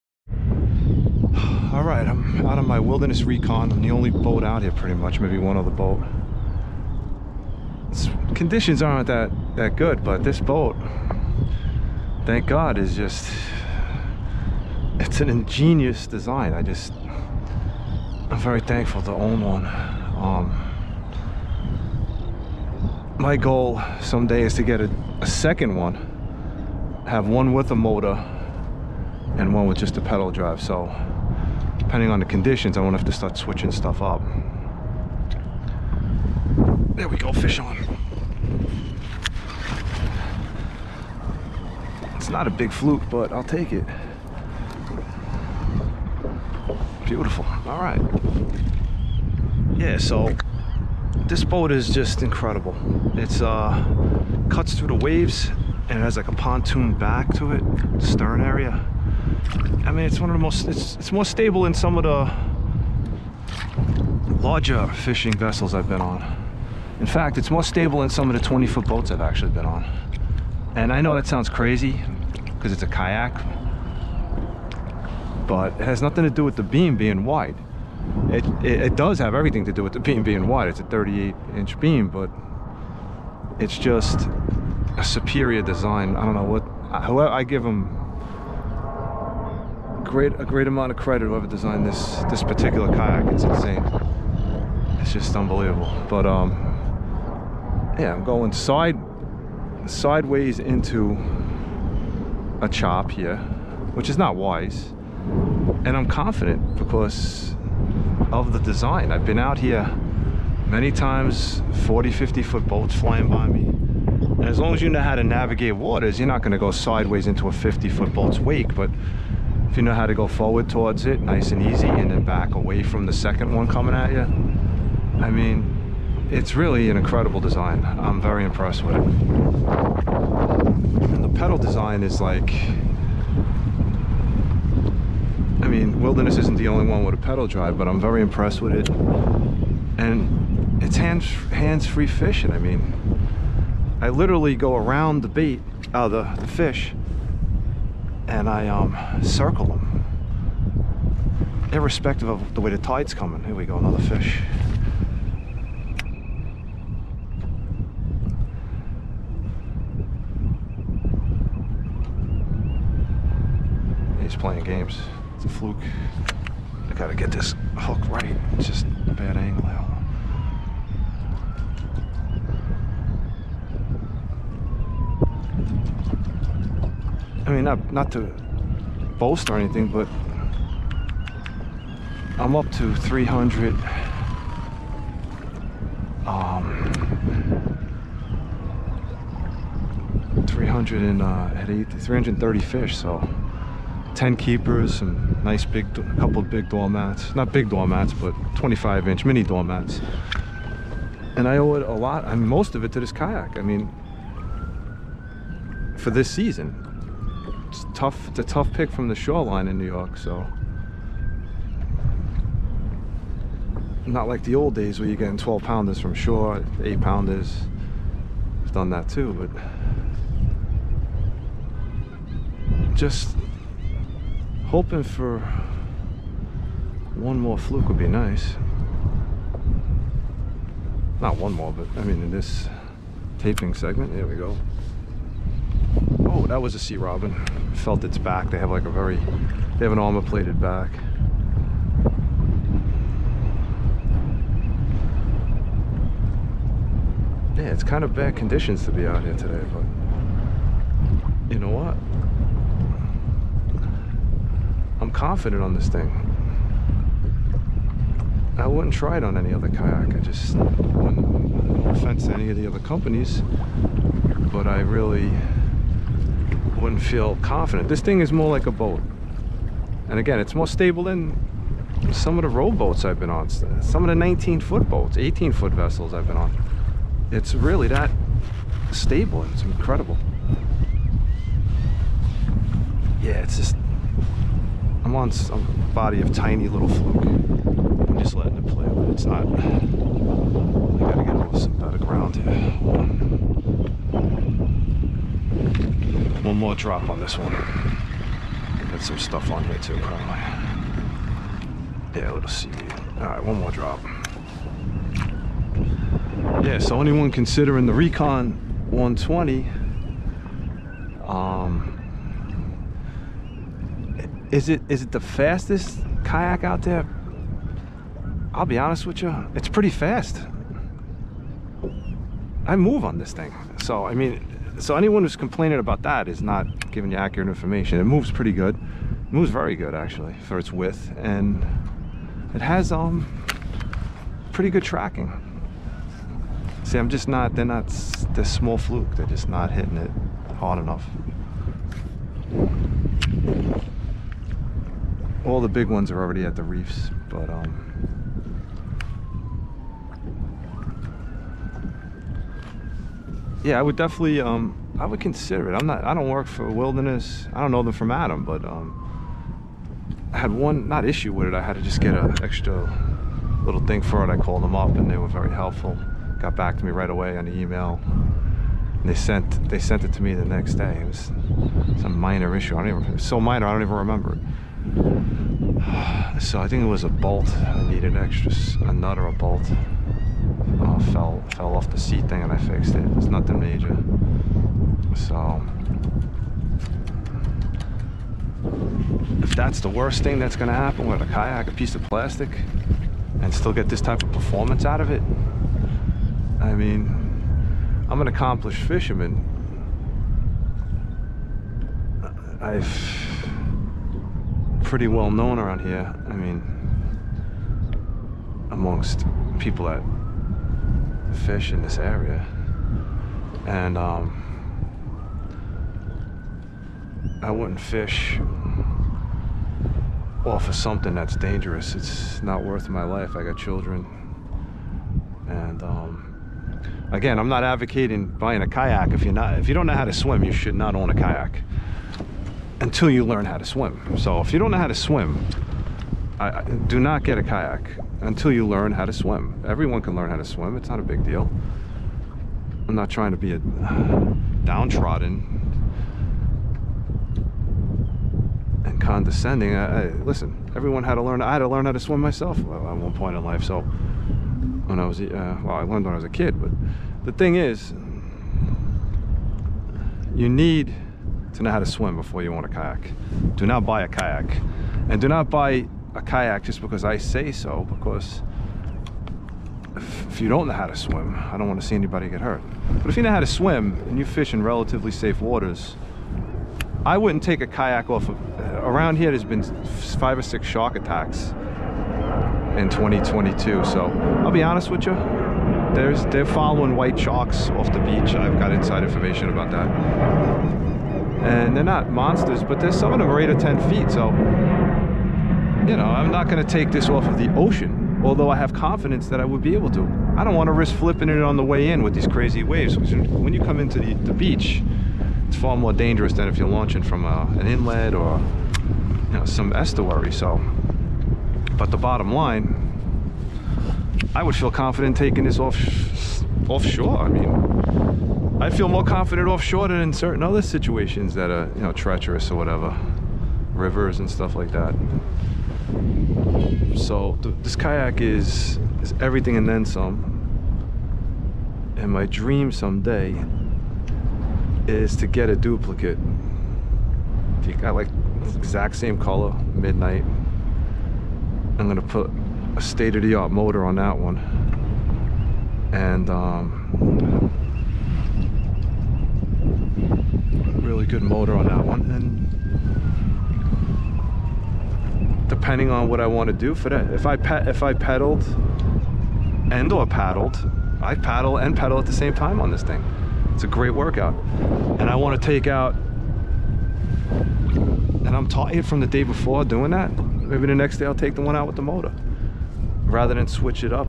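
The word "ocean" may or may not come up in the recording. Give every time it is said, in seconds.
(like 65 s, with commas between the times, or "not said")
497 s.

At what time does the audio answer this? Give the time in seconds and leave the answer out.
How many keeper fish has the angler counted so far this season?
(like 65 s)
194 s.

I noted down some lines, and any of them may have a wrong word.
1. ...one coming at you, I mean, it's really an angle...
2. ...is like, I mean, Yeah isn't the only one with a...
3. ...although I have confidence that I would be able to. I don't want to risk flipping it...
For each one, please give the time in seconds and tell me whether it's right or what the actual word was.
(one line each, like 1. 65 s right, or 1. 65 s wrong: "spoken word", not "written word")
1. 123 s wrong: "incredible", not "angle"
2. 132 s wrong: "Wilderness", not "Yeah"
3. 498 s right.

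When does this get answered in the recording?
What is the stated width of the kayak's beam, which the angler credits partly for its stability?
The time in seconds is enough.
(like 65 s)
80 s.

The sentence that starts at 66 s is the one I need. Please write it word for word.
In fact, it's more stable than some of the 20 foot boats I've actually been on.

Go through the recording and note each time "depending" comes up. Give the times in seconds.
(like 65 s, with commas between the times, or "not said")
31 s, 555 s.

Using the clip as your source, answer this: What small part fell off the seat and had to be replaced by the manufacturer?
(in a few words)
a nut or a bolt.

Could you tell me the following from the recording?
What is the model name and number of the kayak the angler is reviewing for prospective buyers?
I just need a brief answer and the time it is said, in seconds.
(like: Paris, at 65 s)
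Recon 120, at 307 s.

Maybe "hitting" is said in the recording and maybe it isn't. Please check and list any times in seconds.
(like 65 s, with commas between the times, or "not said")
339 s.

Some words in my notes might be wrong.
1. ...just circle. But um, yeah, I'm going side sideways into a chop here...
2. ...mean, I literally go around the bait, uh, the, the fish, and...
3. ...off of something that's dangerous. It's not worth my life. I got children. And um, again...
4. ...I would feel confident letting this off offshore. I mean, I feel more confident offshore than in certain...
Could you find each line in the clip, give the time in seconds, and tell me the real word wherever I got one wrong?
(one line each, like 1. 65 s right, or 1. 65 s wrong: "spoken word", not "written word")
1. 95 s wrong: "unbelievable", not "circle"
2. 142 s right
3. 420 s right
4. 514 s wrong: "taking", not "letting".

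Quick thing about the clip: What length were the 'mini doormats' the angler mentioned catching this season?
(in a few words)
25 inches.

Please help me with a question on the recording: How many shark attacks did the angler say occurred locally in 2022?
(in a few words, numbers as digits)
5 or 6.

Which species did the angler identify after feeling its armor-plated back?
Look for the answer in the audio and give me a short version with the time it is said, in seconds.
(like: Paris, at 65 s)
sea robin, at 236 s.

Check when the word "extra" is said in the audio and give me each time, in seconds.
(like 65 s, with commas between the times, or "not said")
362 s, 378 s.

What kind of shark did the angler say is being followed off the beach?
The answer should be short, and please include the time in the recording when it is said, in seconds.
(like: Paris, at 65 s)
white sharks, at 486 s.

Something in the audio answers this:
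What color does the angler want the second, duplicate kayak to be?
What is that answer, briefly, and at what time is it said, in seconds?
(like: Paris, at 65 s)
midnight, at 539 s.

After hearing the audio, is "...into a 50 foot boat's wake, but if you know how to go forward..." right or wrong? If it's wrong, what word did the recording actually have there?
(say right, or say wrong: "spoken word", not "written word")
right.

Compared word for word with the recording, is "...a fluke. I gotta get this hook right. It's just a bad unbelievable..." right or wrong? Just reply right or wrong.
wrong.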